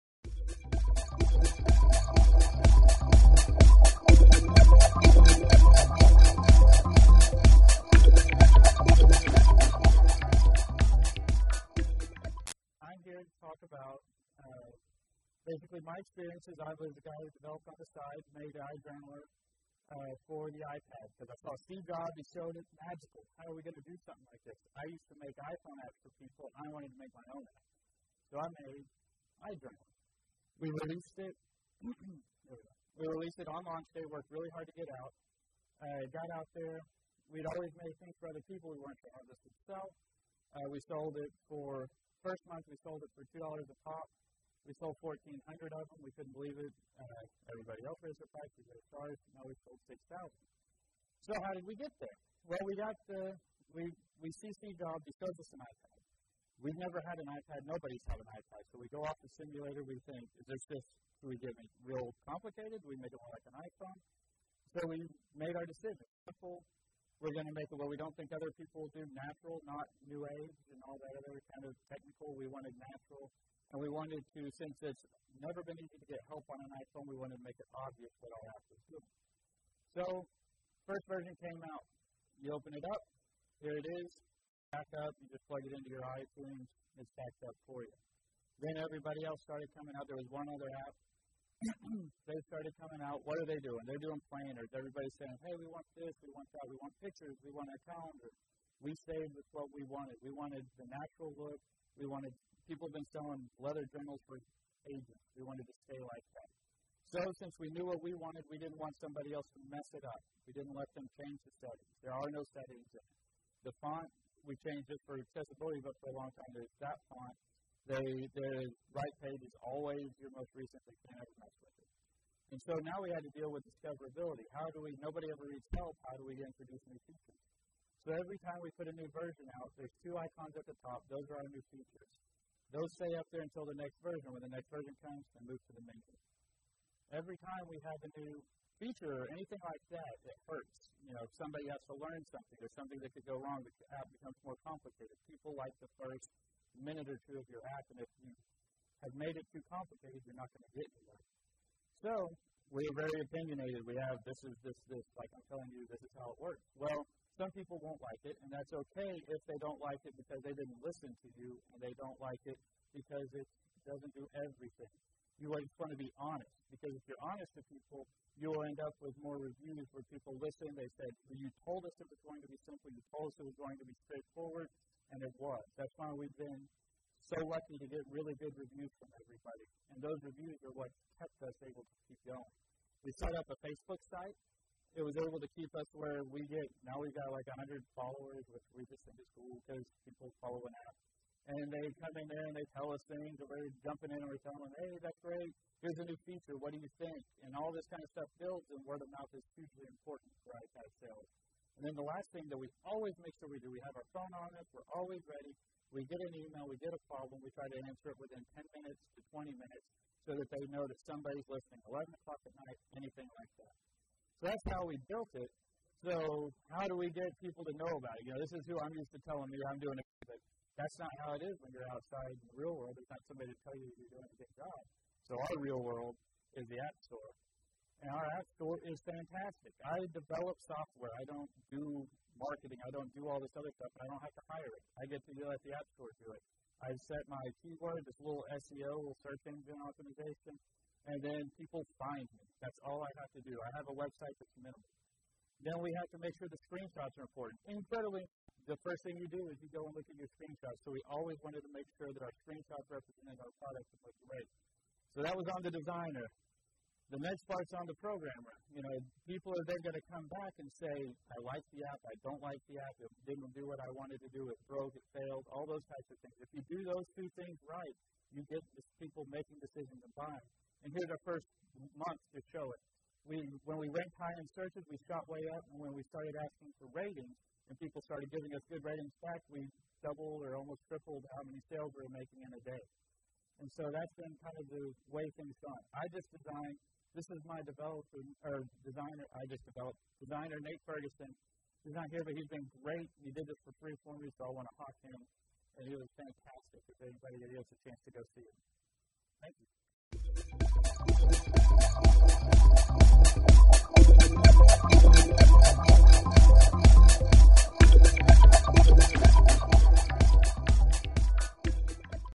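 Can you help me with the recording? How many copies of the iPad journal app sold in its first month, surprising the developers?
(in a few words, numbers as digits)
1,400.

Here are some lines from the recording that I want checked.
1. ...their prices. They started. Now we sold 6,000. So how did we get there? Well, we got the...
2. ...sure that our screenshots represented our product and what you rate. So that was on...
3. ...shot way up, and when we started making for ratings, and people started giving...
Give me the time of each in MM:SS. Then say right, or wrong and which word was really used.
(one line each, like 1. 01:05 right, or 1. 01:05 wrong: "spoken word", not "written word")
1. 00:48 right
2. 04:12 right
3. 04:35 wrong: "asking", not "making".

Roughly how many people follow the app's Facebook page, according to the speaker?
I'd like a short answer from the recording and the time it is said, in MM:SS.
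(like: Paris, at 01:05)
100, at 03:07.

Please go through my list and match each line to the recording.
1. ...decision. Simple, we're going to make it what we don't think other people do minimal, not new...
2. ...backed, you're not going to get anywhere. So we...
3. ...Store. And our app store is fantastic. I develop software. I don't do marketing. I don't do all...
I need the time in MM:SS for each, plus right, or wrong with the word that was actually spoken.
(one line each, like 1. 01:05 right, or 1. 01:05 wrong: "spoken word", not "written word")
1. 01:05 wrong: "natural", not "minimal"
2. 02:29 wrong: "complicated", not "backed"
3. 03:47 right.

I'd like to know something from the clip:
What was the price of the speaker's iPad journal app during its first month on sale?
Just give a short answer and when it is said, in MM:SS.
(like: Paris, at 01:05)
2 dollars, at 00:43.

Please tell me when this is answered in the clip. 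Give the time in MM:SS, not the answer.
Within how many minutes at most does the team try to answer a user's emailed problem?
03:29.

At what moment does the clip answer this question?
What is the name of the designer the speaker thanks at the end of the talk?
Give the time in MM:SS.
04:50.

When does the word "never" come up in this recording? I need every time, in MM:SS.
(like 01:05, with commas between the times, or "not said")
00:56, 01:15.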